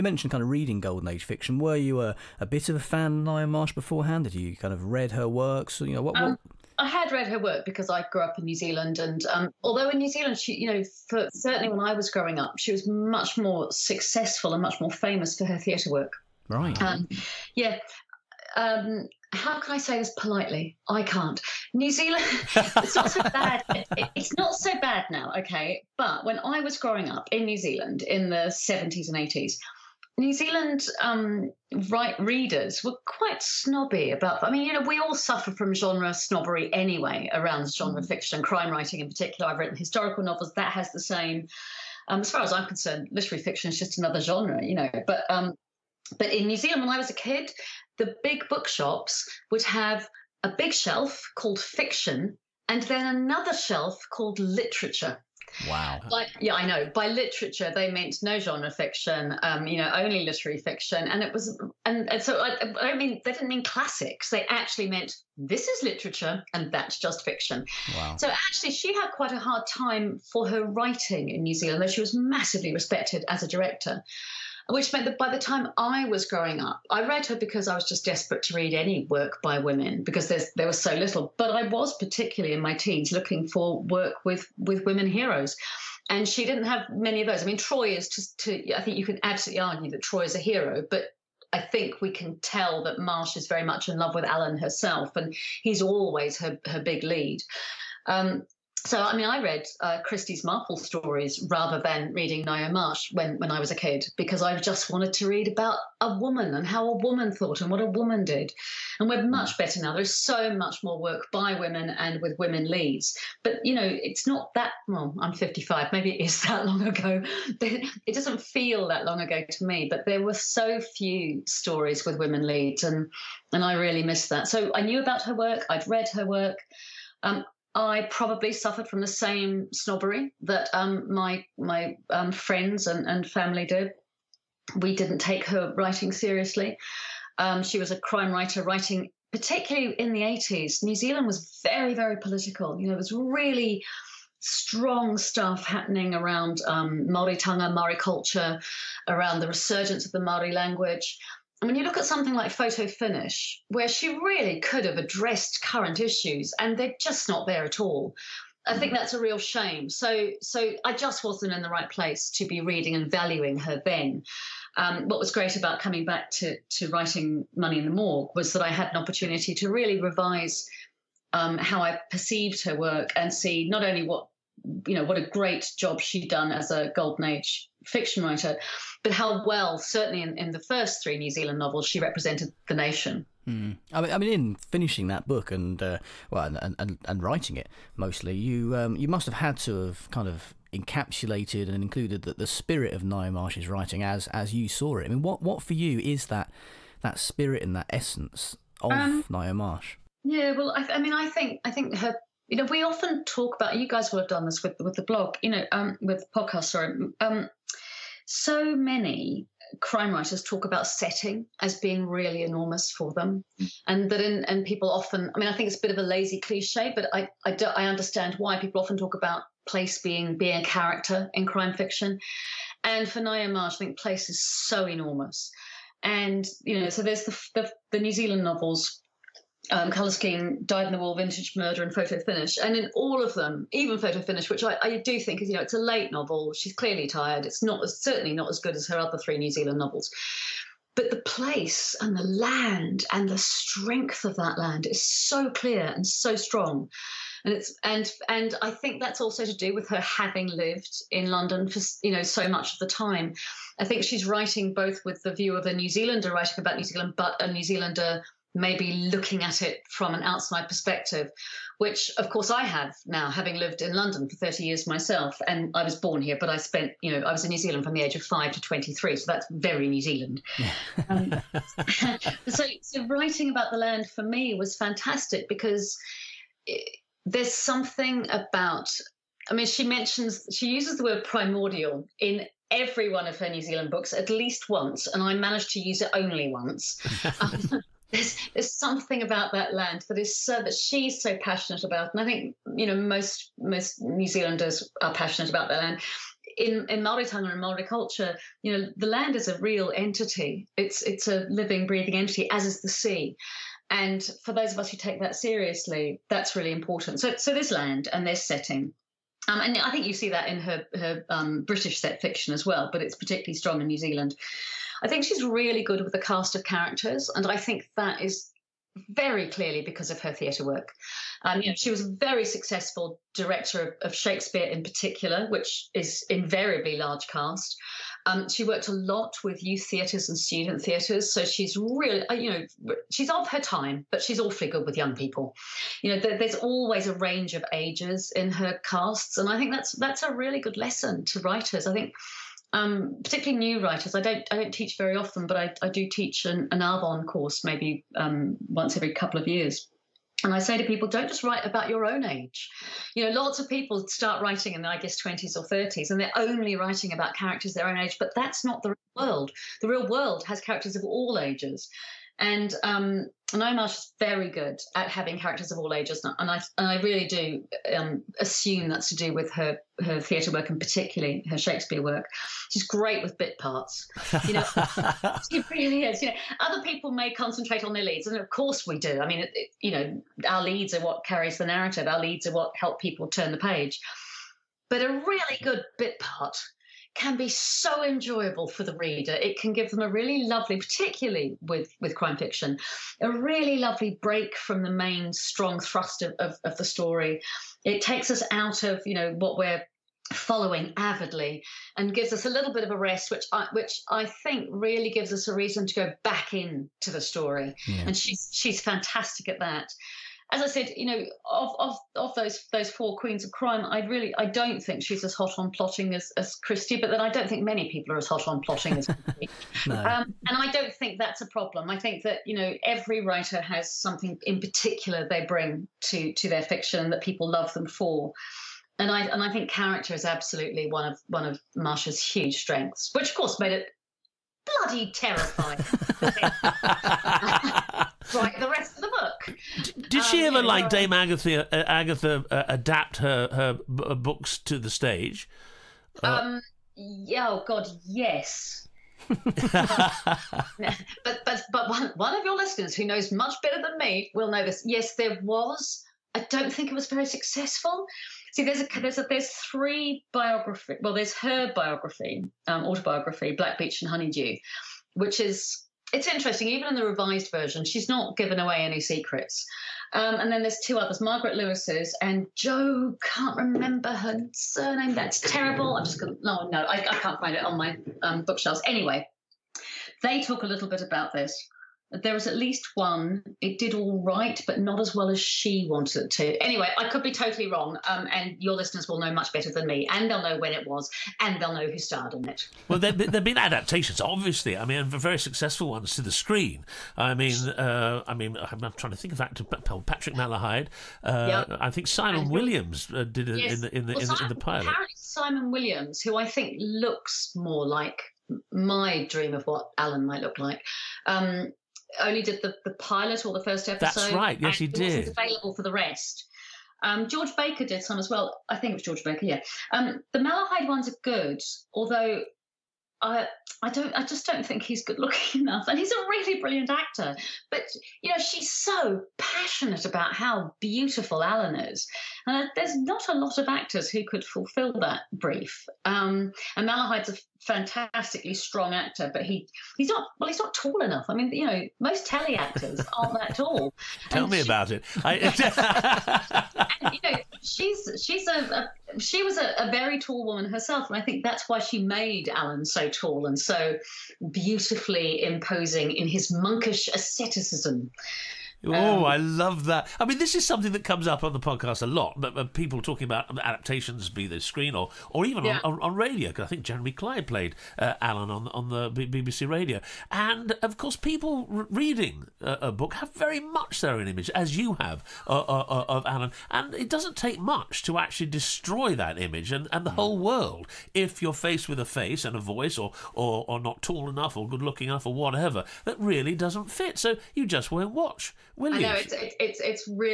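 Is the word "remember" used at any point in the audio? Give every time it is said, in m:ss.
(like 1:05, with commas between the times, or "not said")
7:53.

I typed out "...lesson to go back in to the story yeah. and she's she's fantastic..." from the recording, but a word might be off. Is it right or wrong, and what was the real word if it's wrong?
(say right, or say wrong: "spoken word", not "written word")
wrong: "reason", not "lesson".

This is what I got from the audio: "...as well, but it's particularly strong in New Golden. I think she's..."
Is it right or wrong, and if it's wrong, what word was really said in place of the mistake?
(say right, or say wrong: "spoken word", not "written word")
wrong: "Zealand", not "Golden".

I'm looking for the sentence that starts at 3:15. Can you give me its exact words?
I mean, what what for you is that that spirit and that essence of um, Ngaio Marsh?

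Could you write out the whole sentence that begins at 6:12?
She's great with bit parts, you know.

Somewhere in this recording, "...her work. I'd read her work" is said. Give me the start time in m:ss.
2:05.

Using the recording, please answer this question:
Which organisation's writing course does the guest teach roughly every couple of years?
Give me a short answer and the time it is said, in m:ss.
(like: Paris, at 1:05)
Arvon, at 5:46.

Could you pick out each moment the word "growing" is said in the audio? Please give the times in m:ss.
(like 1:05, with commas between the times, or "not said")
0:12, 0:26, 1:16.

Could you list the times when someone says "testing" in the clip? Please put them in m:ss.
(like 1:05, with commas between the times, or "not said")
not said.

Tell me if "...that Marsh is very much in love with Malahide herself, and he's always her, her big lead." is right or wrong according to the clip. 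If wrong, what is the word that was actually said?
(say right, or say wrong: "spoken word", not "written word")
wrong: "Alleyn", not "Malahide".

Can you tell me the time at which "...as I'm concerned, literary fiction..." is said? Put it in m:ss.
0:42.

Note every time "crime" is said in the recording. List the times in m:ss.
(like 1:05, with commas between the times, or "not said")
0:38, 2:17, 3:29, 3:41, 6:32, 6:53.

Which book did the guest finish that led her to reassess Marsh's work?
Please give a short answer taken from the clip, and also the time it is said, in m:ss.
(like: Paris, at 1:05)
Money in the Morgue, at 2:47.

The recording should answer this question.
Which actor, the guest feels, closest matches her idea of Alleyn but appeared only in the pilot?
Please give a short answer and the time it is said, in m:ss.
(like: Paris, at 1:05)
Simon Williams, at 8:25.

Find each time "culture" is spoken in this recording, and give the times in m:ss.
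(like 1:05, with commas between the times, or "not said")
2:27, 4:57.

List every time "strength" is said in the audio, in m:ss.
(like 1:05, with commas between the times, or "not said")
4:03, 7:12.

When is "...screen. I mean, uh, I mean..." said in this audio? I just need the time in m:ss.
8:16.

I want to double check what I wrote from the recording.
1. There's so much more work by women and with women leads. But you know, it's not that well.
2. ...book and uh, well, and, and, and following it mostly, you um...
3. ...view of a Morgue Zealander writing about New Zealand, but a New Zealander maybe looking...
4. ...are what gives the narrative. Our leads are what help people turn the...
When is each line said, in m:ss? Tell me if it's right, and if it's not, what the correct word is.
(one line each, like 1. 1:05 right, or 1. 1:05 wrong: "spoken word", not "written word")
1. 1:49 right
2. 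3:05 wrong: "writing", not "following"
3. 4:15 wrong: "New", not "Morgue"
4. 6:20 wrong: "carries", not "gives".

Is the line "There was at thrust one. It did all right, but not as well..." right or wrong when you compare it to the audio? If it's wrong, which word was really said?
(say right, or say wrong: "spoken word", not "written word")
wrong: "least", not "thrust".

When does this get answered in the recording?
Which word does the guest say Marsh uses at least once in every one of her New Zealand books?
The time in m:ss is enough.
4:41.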